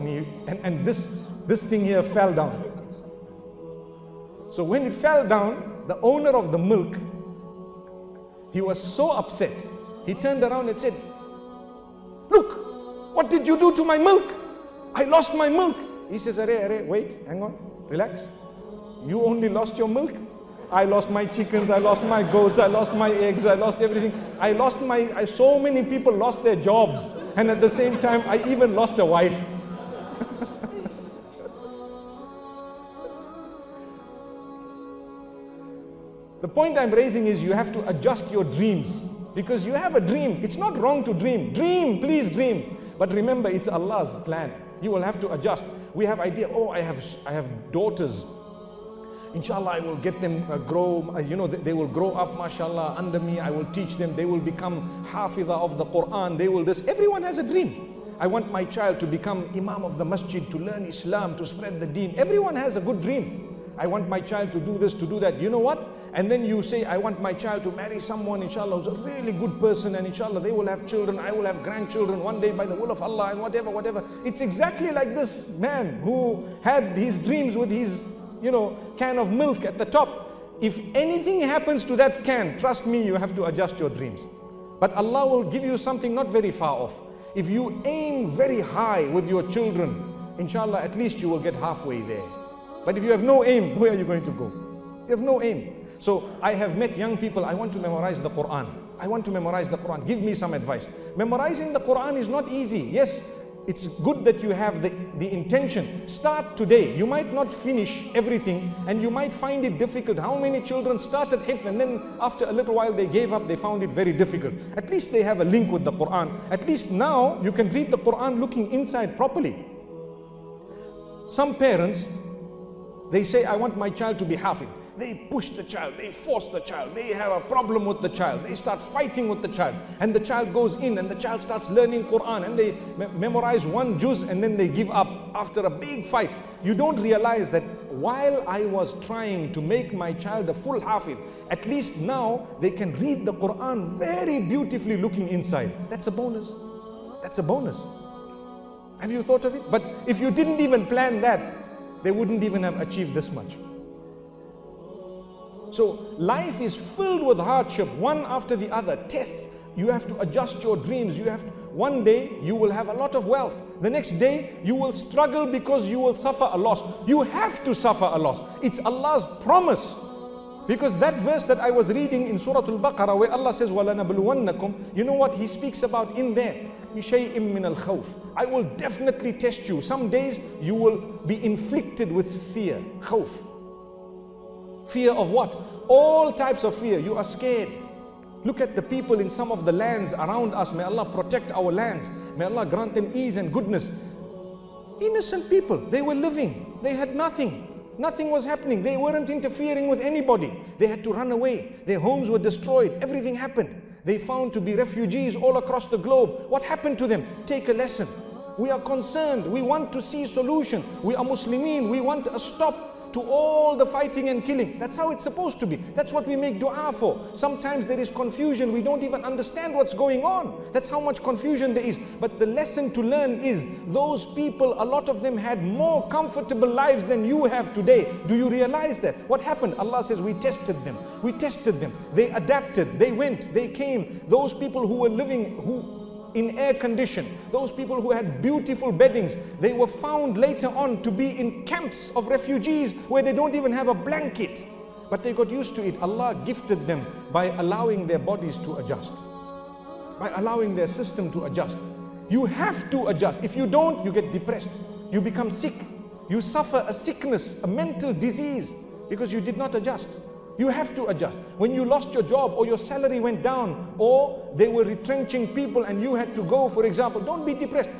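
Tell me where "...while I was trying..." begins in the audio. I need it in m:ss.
2:17.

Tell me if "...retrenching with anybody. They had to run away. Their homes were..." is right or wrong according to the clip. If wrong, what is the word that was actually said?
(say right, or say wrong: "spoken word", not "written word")
wrong: "interfering", not "retrenching".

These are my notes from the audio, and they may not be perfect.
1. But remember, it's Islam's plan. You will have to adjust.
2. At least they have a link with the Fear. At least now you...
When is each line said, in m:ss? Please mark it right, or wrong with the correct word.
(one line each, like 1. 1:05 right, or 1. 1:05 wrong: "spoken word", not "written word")
1. 0:42 wrong: "Allah", not "Islam"
2. 1:54 wrong: "Quran", not "Fear".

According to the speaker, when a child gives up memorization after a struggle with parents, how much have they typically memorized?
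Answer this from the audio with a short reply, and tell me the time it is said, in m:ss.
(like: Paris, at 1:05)
One juz, at 2:13.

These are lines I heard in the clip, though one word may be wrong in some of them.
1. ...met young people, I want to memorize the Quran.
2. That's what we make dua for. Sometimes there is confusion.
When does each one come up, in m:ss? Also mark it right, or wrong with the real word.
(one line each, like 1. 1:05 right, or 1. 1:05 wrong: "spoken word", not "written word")
1. 1:36 right
2. 3:35 right.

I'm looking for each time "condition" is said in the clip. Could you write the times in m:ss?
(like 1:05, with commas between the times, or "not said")
3:56.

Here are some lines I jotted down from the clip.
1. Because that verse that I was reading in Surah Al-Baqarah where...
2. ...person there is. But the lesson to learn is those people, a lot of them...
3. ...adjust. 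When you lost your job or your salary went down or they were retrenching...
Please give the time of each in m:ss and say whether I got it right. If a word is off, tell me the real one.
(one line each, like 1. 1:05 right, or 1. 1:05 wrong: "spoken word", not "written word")
1. 2:50 right
2. 3:41 wrong: "confusion", not "person"
3. 4:21 right.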